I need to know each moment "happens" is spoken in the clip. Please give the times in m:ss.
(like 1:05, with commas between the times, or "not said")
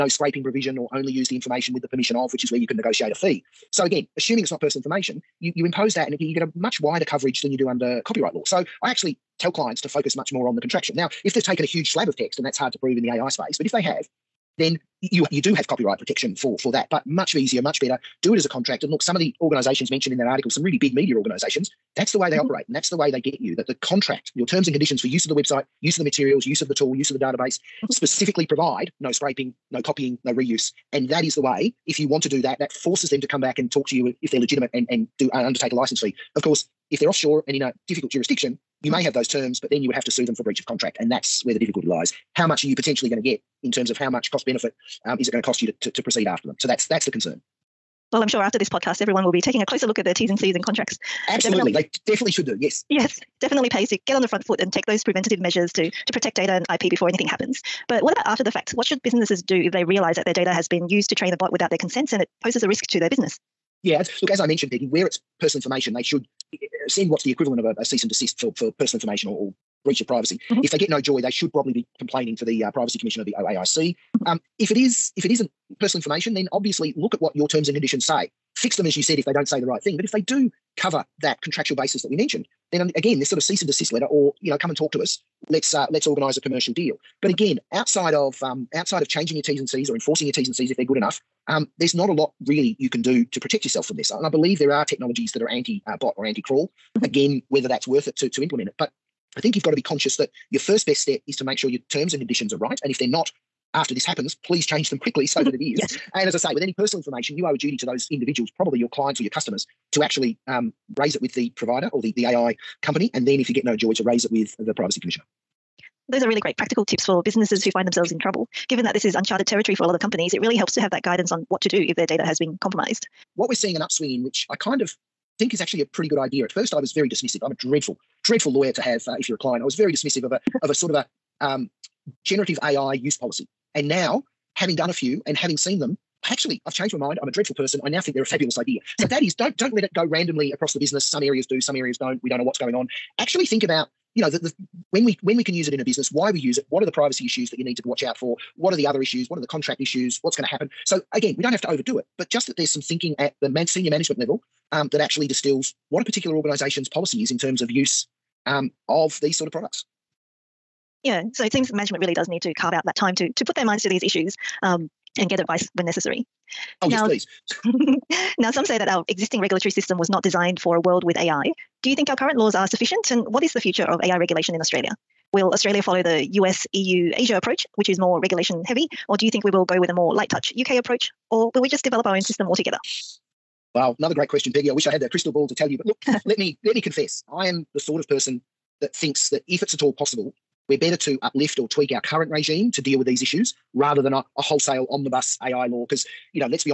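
0:57, 1:44, 2:30.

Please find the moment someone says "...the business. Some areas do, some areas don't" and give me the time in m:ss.
2:20.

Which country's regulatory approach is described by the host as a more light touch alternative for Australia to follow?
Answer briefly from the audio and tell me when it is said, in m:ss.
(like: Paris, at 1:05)
UK, at 3:00.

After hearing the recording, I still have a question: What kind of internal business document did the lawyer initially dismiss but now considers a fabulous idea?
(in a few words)
Generative AI use policy.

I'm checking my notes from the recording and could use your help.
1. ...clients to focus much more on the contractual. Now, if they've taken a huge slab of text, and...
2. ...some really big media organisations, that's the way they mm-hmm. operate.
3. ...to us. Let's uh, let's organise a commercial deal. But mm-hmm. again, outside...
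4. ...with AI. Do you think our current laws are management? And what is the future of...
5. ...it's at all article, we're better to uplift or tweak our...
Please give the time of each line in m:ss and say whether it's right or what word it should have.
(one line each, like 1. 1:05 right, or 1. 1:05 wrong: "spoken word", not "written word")
1. 0:09 right
2. 0:20 right
3. 1:24 right
4. 2:51 wrong: "sufficient", not "management"
5. 3:09 wrong: "possible", not "article".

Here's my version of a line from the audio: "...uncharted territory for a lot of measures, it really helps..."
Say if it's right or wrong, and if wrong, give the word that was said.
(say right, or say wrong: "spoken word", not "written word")
wrong: "companies", not "measures".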